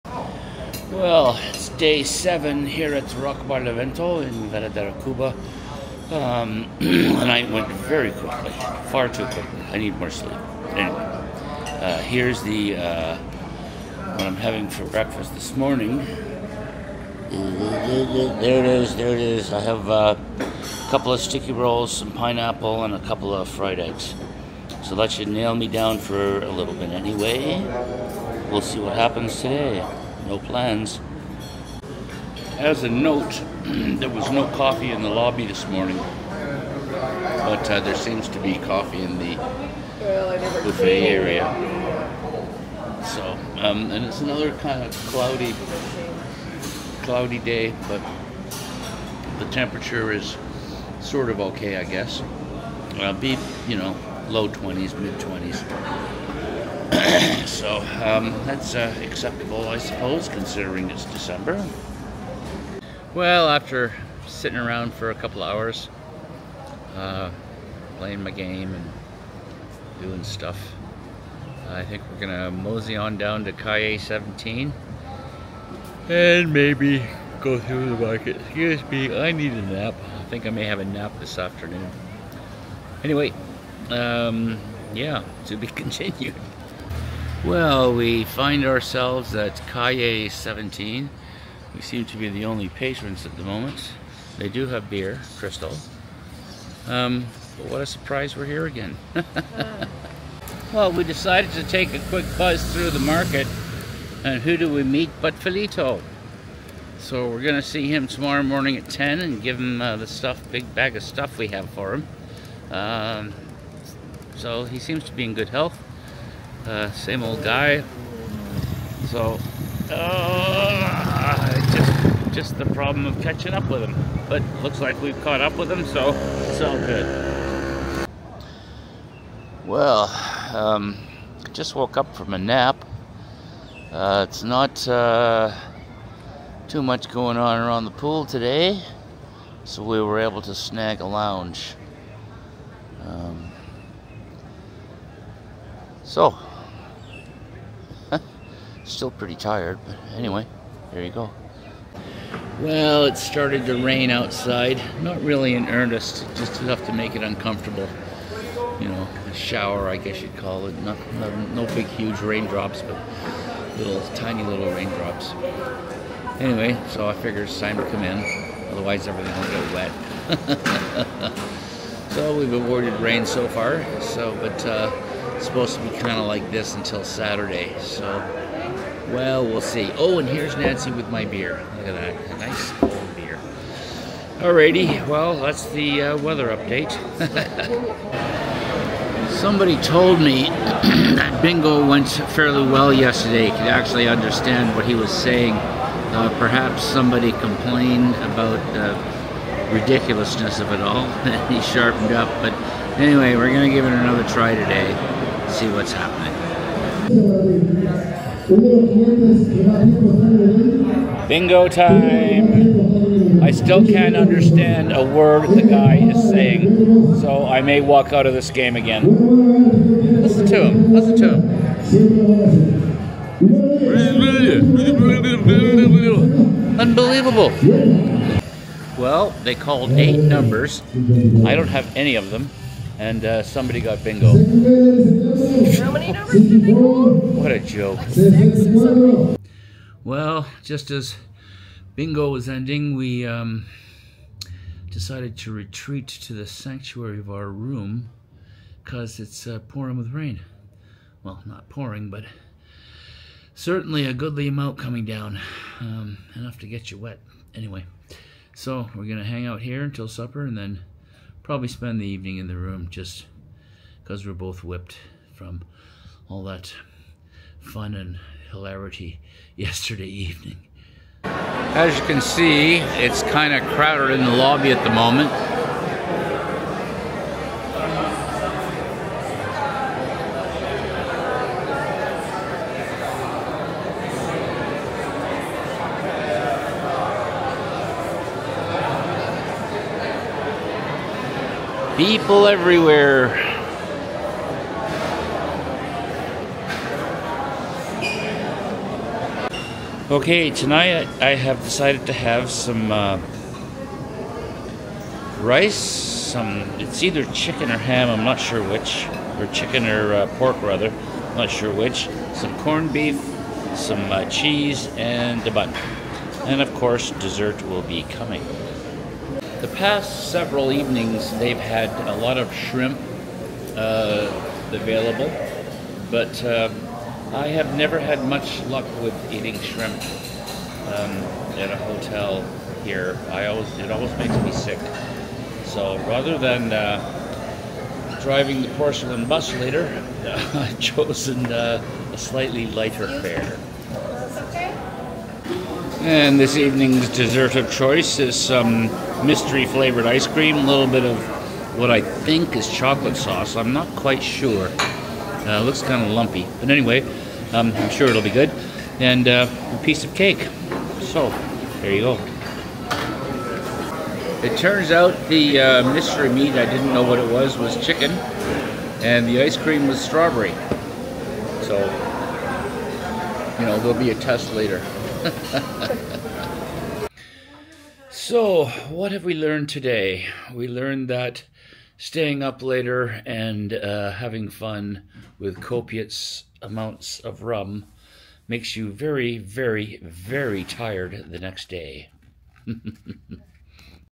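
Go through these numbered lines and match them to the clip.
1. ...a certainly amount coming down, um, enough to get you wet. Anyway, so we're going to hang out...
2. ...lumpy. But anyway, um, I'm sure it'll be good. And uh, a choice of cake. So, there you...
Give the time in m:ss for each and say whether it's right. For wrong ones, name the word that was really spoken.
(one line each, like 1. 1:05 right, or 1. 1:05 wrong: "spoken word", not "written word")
1. 4:14 wrong: "goodly", not "certainly"
2. 5:56 wrong: "piece", not "choice".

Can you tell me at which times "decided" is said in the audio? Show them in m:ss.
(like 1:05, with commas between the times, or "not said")
1:41, 4:04, 5:01.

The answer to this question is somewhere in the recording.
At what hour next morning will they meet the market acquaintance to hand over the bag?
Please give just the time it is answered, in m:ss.
1:48.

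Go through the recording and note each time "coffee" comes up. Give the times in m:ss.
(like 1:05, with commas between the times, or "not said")
0:34, 0:38.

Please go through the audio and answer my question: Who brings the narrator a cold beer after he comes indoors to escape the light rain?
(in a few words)
Nancy.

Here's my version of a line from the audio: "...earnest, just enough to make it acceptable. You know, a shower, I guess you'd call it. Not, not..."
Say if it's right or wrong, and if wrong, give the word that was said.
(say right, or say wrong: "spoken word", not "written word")
wrong: "uncomfortable", not "acceptable".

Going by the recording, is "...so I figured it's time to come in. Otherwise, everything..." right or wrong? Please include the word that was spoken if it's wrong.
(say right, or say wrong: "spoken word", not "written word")
right.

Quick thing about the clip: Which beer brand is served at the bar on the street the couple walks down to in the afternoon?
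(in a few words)
Cristal.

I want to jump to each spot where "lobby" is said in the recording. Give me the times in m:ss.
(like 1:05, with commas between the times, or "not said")
0:35, 4:34.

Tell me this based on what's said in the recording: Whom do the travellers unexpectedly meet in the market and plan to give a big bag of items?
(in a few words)
Felito.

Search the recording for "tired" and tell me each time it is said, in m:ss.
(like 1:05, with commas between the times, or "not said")
2:29, 6:30.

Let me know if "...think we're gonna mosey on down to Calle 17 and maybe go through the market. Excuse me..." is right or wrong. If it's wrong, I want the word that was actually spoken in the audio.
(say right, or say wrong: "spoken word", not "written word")
right.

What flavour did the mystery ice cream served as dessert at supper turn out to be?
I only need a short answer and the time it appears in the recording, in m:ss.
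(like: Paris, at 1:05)
Strawberry, at 6:10.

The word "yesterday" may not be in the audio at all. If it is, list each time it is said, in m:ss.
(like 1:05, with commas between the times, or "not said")
3:12, 4:29.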